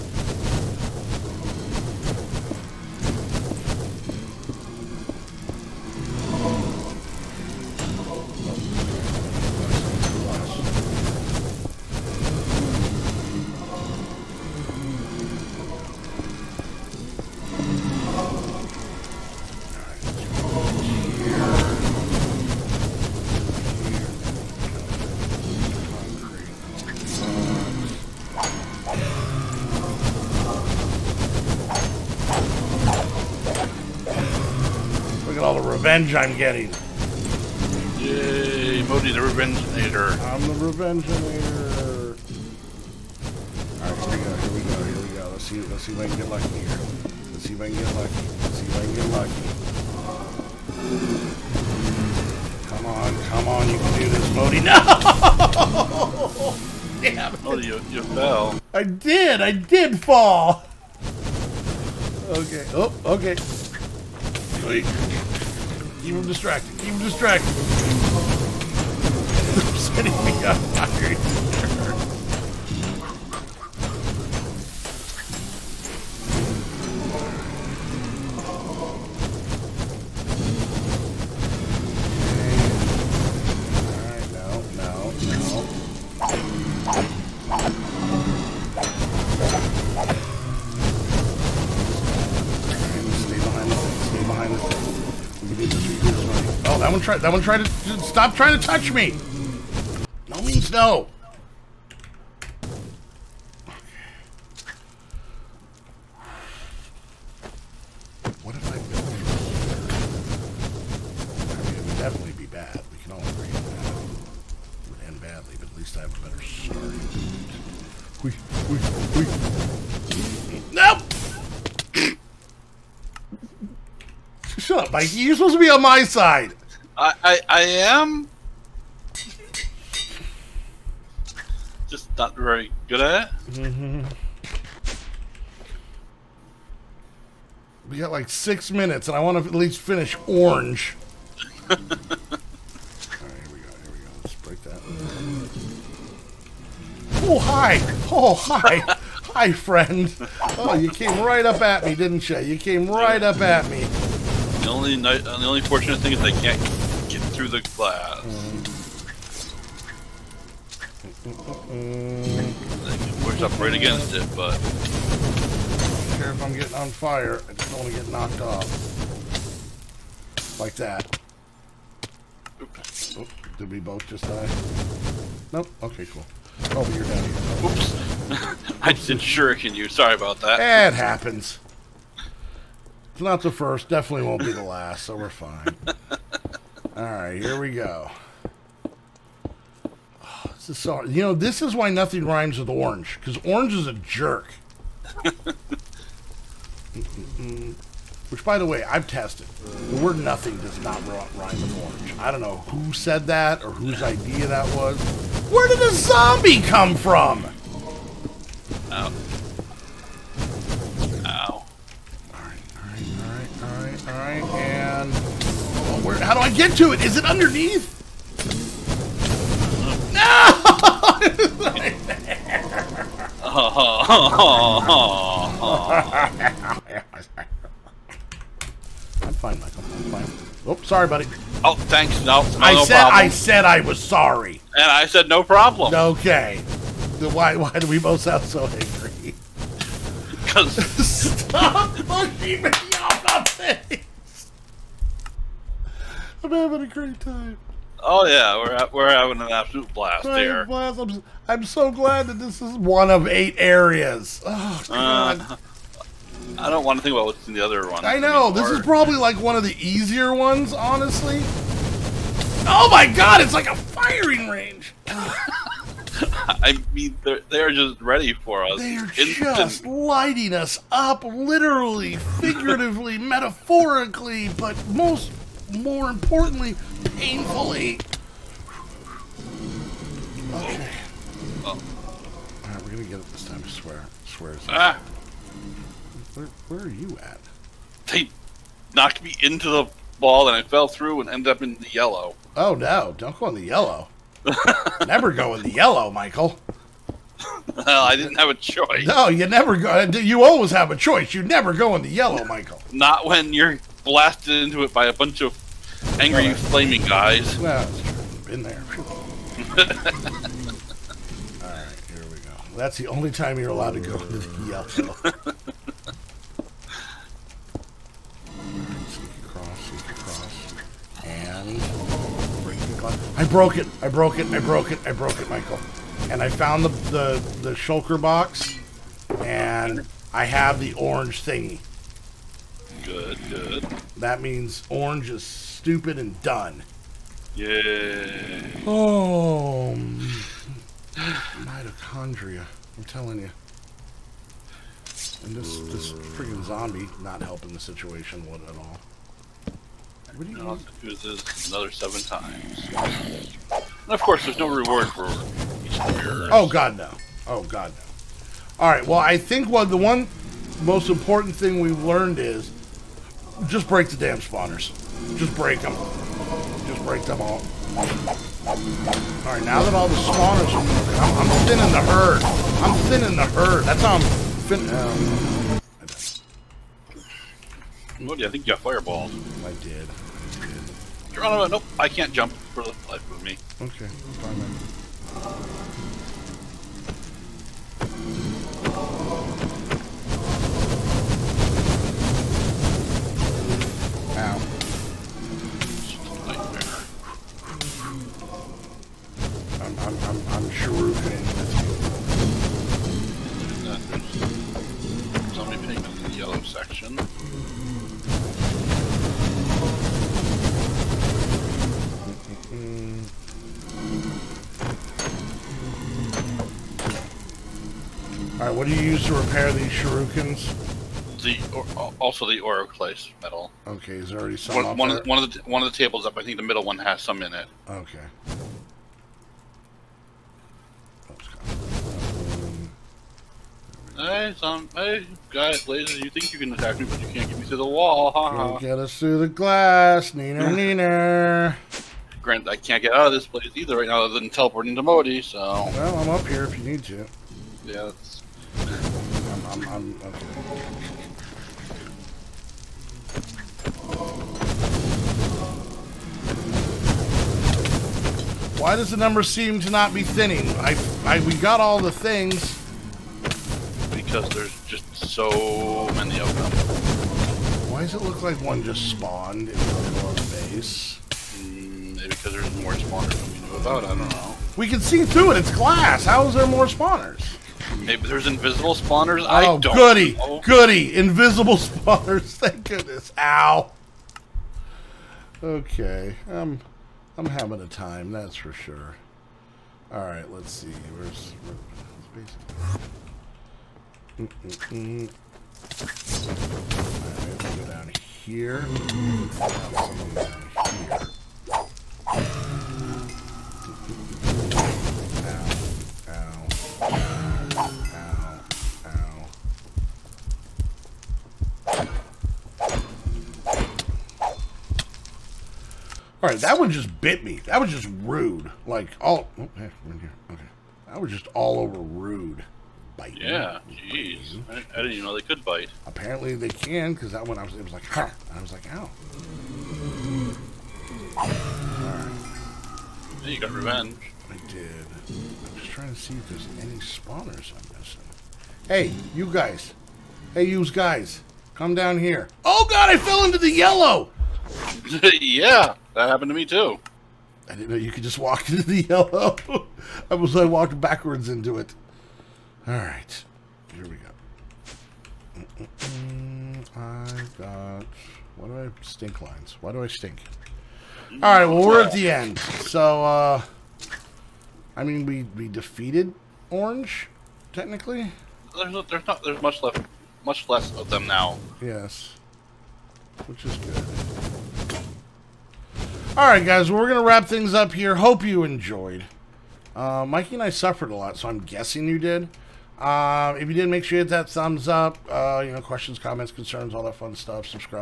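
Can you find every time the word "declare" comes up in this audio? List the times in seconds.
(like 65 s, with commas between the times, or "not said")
not said.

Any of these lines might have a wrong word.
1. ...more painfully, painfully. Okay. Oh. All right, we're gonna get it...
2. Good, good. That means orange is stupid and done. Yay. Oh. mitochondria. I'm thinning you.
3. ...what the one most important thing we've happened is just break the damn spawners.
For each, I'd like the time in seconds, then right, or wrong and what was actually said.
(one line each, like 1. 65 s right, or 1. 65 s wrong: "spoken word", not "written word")
1. 275 s wrong: "importantly", not "painfully"
2. 333 s wrong: "telling", not "thinning"
3. 359 s wrong: "learned", not "happened".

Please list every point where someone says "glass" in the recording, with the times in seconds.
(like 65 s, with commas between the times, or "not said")
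157 s, 439 s, 475 s.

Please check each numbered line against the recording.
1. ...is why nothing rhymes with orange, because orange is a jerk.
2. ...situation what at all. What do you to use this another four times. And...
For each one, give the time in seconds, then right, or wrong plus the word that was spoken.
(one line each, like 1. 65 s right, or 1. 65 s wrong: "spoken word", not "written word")
1. 191 s right
2. 347 s wrong: "seven", not "four".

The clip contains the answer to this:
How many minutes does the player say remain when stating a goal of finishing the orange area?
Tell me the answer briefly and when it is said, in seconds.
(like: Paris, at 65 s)
6, at 138 s.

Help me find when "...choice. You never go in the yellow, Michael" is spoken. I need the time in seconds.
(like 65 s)
300 s.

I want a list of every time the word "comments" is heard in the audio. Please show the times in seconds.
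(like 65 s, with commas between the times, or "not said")
586 s.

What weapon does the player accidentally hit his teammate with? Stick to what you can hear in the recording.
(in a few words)
Shuriken.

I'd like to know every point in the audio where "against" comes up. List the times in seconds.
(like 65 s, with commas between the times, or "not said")
163 s.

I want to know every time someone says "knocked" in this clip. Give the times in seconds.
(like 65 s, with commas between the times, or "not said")
168 s, 288 s.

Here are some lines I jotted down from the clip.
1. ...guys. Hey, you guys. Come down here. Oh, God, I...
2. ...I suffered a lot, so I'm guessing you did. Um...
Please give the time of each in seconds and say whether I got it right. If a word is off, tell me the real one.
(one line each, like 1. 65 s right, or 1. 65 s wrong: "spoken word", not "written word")
1. 539 s right
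2. 580 s right.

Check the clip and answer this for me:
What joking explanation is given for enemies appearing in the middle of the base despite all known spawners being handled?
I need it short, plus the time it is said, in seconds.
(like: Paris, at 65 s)
Invisible spawners, at 478 s.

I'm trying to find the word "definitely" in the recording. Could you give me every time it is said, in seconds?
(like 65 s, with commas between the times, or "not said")
111 s, 183 s.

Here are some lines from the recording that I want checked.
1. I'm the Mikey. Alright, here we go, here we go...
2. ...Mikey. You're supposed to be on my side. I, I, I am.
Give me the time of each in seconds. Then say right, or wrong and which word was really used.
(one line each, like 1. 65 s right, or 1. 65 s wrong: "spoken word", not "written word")
1. 40 s wrong: "Revengeinator", not "Mikey"
2. 124 s right.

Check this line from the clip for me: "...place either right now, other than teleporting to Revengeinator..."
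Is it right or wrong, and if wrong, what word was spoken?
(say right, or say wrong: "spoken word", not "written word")
wrong: "Modii", not "Revengeinator".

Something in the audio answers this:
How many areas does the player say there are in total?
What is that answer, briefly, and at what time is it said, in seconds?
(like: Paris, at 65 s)
8, at 253 s.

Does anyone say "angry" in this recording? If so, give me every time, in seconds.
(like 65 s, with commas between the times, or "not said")
238 s, 306 s.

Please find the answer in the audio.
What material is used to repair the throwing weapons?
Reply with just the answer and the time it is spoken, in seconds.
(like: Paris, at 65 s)
Oroclase metal, at 422 s.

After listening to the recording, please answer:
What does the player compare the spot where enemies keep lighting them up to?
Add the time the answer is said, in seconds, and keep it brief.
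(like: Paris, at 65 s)
A firing range, at 263 s.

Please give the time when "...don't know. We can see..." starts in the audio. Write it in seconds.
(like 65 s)
474 s.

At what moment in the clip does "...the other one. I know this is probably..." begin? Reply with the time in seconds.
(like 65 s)
257 s.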